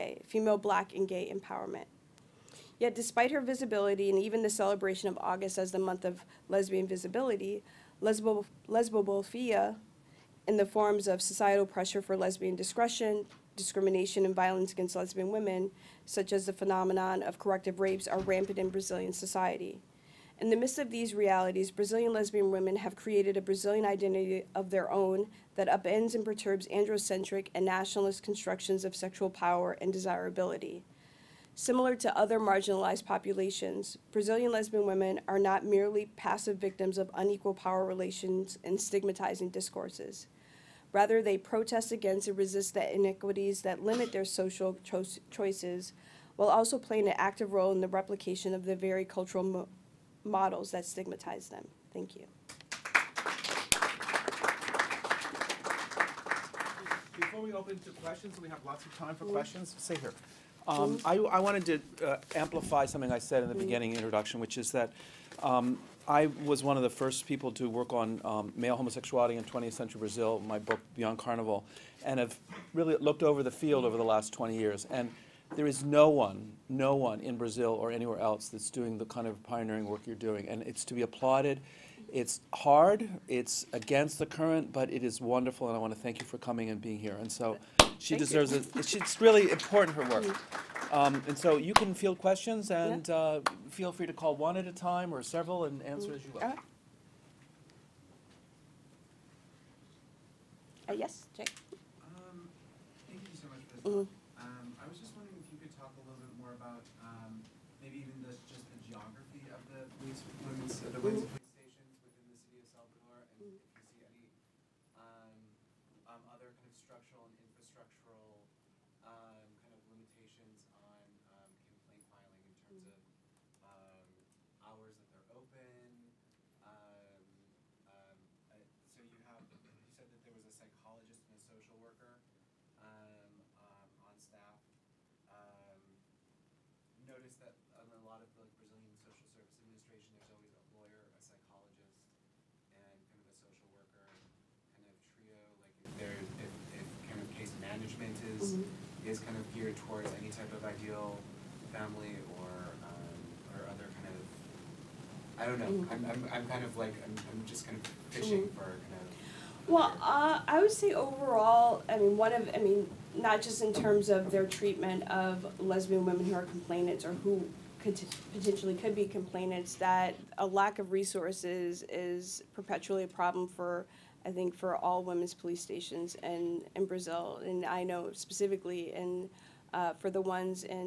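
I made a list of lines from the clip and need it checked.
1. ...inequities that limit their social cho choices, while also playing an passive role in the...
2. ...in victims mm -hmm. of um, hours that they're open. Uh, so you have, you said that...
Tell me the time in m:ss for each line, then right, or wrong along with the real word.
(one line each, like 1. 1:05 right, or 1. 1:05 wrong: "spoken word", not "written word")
1. 0:42 wrong: "active", not "passive"
2. 2:02 wrong: "terms", not "victims".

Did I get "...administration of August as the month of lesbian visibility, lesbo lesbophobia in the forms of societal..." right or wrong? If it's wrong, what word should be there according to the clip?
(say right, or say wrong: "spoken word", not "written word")
wrong: "celebration", not "administration".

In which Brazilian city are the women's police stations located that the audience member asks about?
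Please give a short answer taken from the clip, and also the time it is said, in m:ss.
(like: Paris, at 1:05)
Salvador, at 1:52.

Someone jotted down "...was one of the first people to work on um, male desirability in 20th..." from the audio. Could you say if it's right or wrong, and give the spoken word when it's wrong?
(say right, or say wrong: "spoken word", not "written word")
wrong: "homosexuality", not "desirability".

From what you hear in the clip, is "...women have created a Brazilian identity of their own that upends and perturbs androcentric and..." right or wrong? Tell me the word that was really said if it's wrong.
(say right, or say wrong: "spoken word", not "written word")
right.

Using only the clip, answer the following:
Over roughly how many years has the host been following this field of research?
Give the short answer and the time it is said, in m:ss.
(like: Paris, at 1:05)
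20 years, at 1:14.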